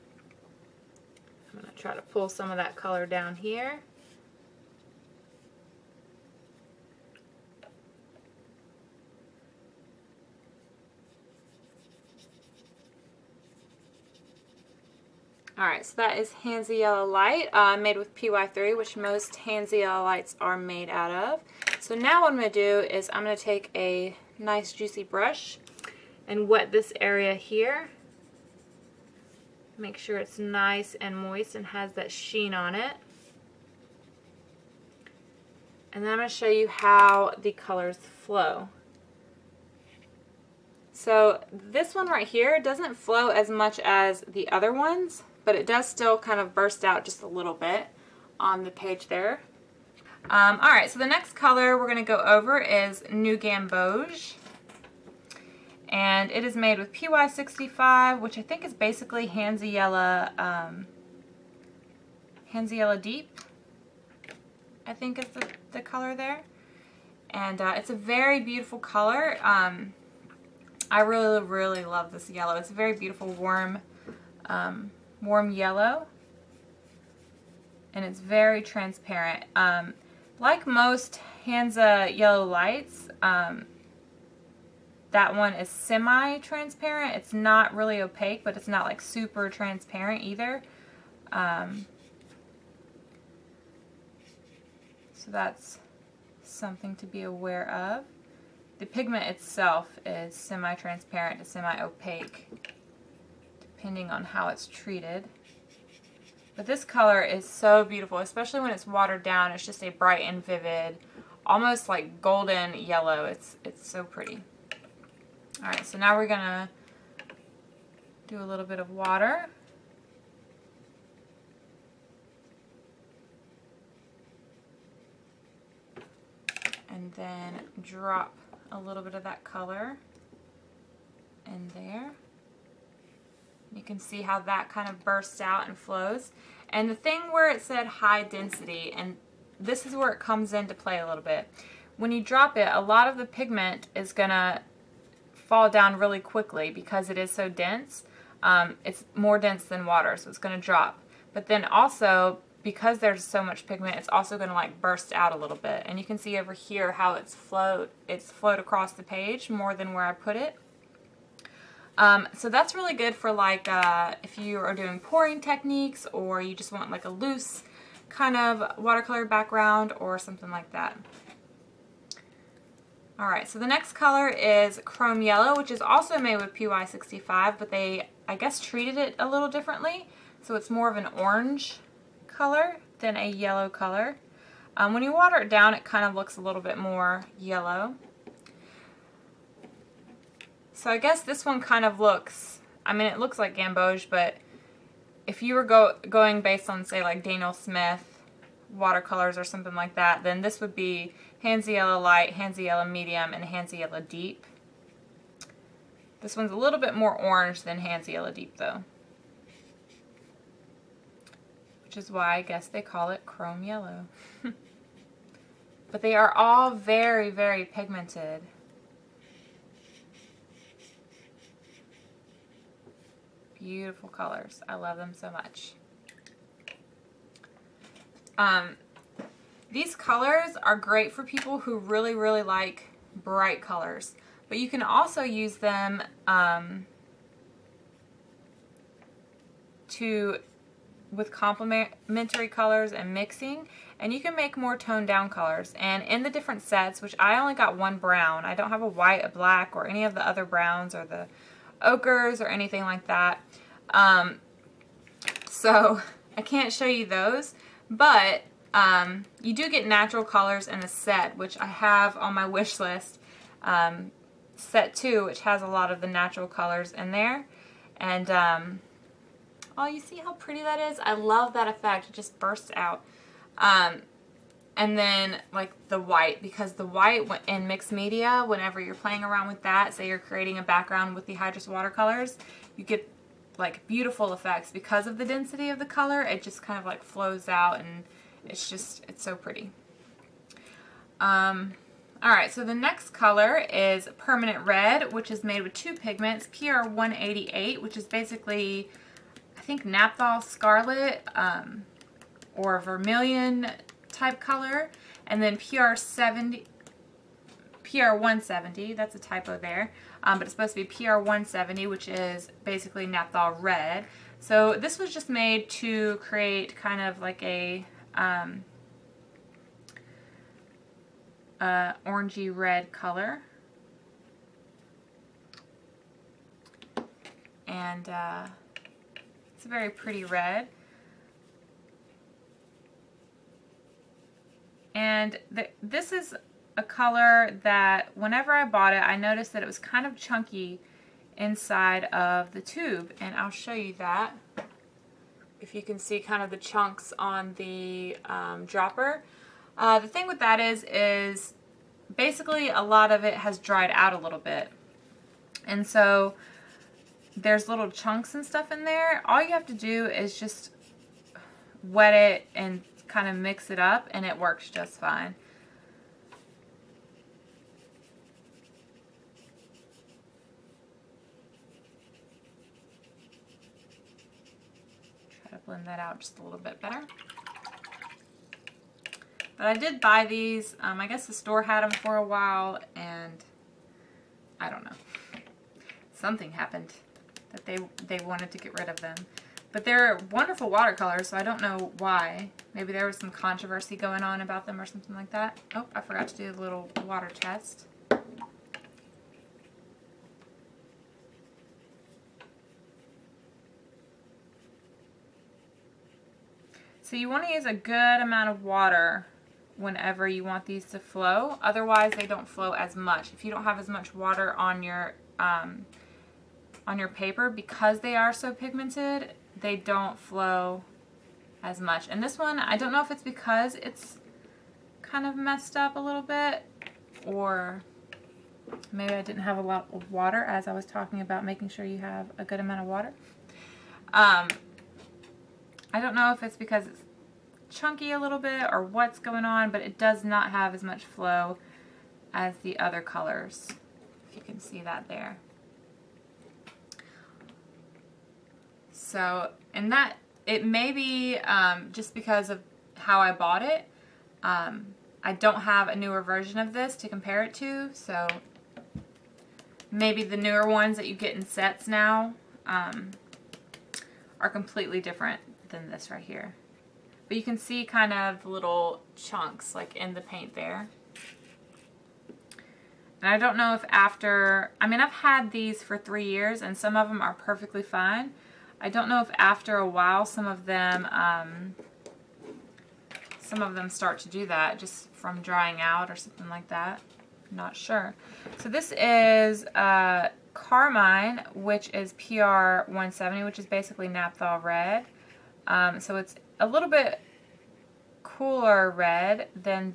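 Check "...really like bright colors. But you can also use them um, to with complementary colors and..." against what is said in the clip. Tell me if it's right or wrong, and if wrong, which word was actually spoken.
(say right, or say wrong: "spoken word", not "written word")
right.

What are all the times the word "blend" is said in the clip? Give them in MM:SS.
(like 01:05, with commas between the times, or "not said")
06:15.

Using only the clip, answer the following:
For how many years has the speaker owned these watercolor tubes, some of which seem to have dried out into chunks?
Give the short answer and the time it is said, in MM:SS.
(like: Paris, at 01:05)
3, at 07:55.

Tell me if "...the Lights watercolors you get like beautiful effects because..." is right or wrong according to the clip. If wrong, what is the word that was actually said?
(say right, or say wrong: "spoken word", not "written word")
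wrong: "Hydrus", not "Lights".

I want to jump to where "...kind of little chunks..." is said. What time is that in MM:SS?
07:47.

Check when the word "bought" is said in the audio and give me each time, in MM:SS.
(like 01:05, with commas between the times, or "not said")
05:38, 07:33.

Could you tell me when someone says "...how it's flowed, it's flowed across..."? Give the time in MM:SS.
02:36.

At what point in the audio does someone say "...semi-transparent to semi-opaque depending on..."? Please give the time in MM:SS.
01:40.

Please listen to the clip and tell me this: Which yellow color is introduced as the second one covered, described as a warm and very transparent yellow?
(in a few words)
New Gamboge.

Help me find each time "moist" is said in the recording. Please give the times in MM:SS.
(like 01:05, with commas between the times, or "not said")
00:31.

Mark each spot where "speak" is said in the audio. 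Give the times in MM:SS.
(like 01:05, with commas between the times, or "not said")
not said.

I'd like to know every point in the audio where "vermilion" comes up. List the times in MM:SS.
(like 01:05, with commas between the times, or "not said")
05:02.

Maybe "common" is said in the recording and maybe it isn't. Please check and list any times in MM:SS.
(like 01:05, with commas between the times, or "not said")
not said.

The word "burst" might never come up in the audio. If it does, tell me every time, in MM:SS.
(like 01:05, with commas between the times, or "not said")
00:46, 02:15, 02:34, 04:32.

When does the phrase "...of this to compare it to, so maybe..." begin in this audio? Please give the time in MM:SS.
07:36.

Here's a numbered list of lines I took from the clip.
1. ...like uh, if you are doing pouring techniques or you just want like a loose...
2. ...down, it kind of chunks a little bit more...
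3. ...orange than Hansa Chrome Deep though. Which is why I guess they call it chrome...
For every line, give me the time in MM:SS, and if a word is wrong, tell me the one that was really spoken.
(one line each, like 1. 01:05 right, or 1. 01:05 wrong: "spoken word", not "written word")
1. 02:43 right
2. 03:05 wrong: "looks", not "chunks"
3. 03:27 wrong: "Yellow", not "Chrome".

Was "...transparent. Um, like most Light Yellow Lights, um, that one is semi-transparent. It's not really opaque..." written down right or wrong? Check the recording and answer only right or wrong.
wrong.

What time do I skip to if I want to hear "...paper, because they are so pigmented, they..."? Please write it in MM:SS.
06:57.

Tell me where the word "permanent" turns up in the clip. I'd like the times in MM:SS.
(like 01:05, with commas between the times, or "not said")
04:54.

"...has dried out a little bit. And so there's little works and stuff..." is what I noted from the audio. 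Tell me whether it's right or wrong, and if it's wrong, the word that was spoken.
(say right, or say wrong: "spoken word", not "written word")
wrong: "chunks", not "works".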